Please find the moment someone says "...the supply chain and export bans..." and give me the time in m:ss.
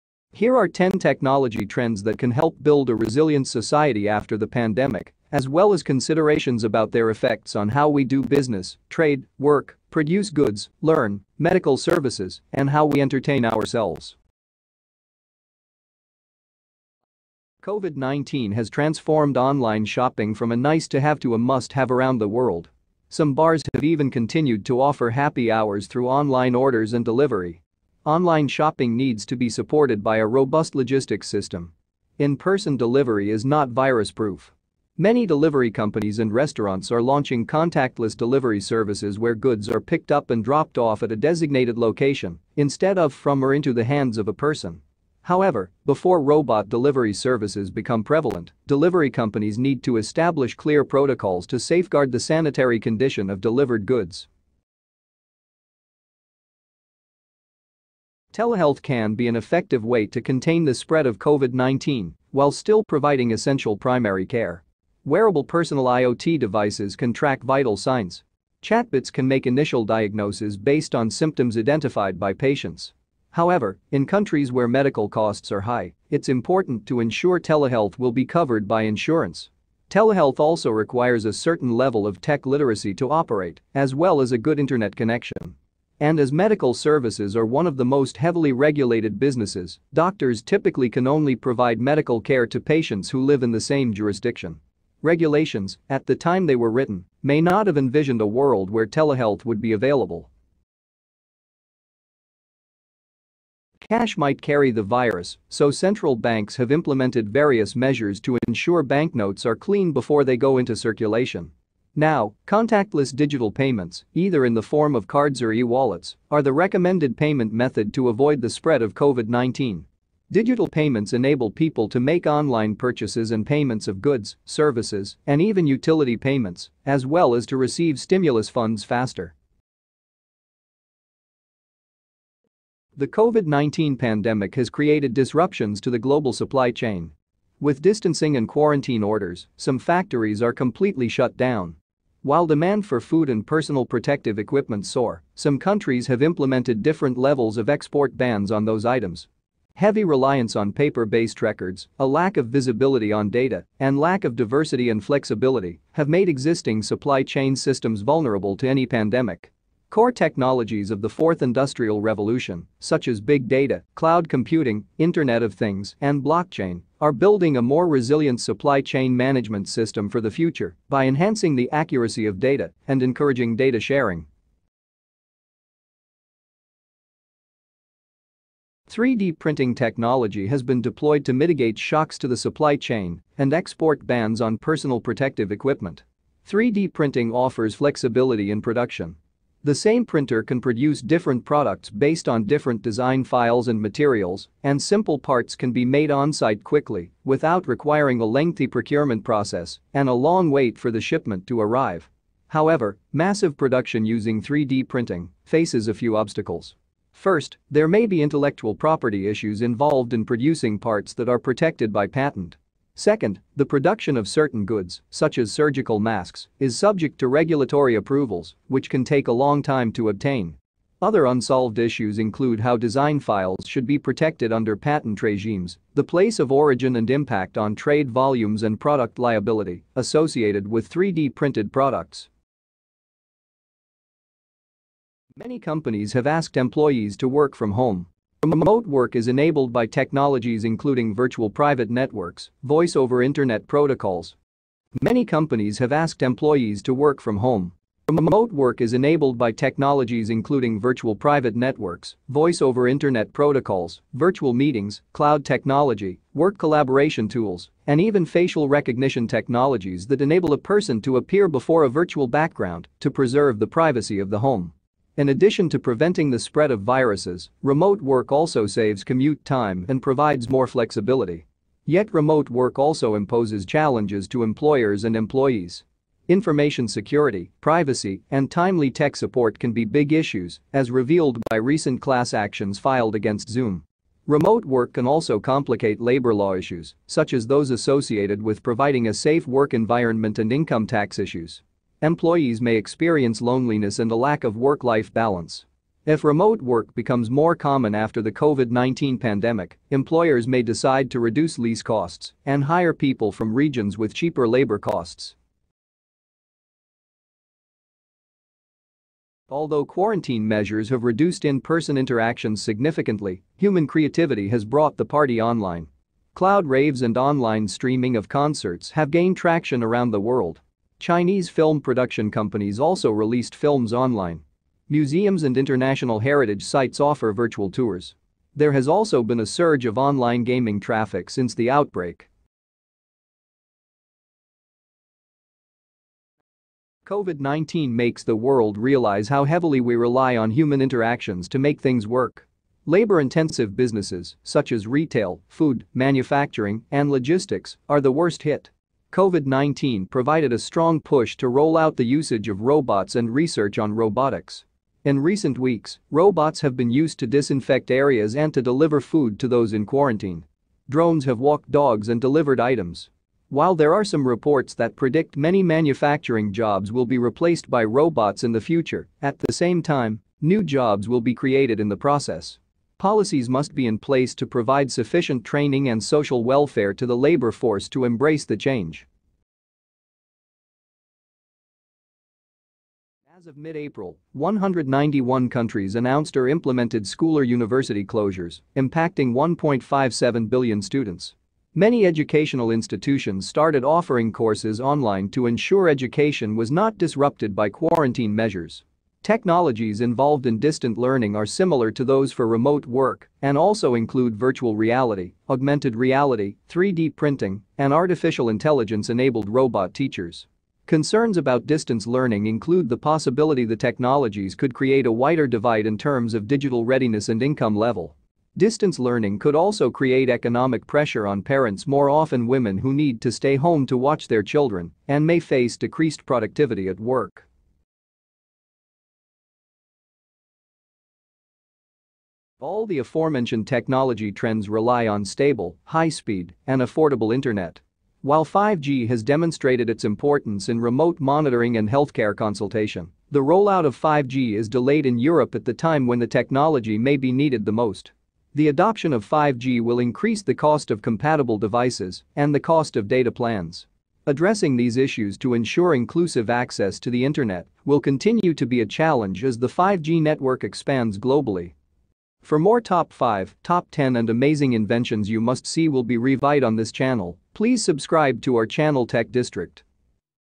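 3:02.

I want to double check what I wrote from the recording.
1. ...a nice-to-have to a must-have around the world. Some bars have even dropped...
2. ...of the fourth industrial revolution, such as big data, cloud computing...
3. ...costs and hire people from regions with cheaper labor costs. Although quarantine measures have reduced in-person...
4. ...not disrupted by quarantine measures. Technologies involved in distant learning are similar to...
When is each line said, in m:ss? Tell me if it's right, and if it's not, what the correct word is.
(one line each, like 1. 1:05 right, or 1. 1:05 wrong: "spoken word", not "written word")
1. 0:20 wrong: "continued", not "dropped"
2. 2:40 right
3. 5:01 right
4. 6:36 right.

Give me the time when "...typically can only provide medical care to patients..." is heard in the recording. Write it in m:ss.
1:30.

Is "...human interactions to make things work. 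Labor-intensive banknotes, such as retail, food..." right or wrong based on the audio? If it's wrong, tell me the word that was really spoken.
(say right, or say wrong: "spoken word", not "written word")
wrong: "businesses", not "banknotes".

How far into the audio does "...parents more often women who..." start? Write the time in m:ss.
7:01.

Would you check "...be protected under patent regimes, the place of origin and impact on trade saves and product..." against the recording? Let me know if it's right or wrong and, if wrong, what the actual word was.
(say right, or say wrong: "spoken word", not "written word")
wrong: "volumes", not "saves".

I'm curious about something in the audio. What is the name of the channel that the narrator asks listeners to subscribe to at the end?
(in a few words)
Tech District.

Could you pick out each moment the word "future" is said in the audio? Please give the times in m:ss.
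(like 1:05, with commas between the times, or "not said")
2:50, 6:08.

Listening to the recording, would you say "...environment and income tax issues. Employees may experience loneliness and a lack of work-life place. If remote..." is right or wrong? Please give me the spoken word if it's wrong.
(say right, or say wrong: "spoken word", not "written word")
wrong: "balance", not "place".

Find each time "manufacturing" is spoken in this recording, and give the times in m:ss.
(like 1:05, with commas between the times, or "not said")
5:45, 6:05.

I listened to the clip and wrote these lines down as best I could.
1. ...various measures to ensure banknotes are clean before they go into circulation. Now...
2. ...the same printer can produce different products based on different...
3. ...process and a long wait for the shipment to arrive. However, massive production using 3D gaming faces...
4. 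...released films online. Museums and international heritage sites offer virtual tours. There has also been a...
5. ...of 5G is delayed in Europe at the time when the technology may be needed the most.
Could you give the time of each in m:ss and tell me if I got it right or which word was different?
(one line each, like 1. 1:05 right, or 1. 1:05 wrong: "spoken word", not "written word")
1. 1:47 right
2. 3:09 right
3. 3:19 wrong: "printing", not "gaming"
4. 5:23 right
5. 7:23 right.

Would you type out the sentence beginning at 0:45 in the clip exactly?
However, before robot delivery services become prevalent, delivery companies need to establish clear protocols to safeguard the sanitary condition of delivered goods.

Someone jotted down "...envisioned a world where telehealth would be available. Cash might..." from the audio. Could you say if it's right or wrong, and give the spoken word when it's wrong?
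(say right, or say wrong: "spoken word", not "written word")
right.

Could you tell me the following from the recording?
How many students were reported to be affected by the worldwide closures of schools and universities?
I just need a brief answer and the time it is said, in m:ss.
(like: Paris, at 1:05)
1.57 billion, at 6:29.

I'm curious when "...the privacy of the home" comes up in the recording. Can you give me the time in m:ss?
4:23.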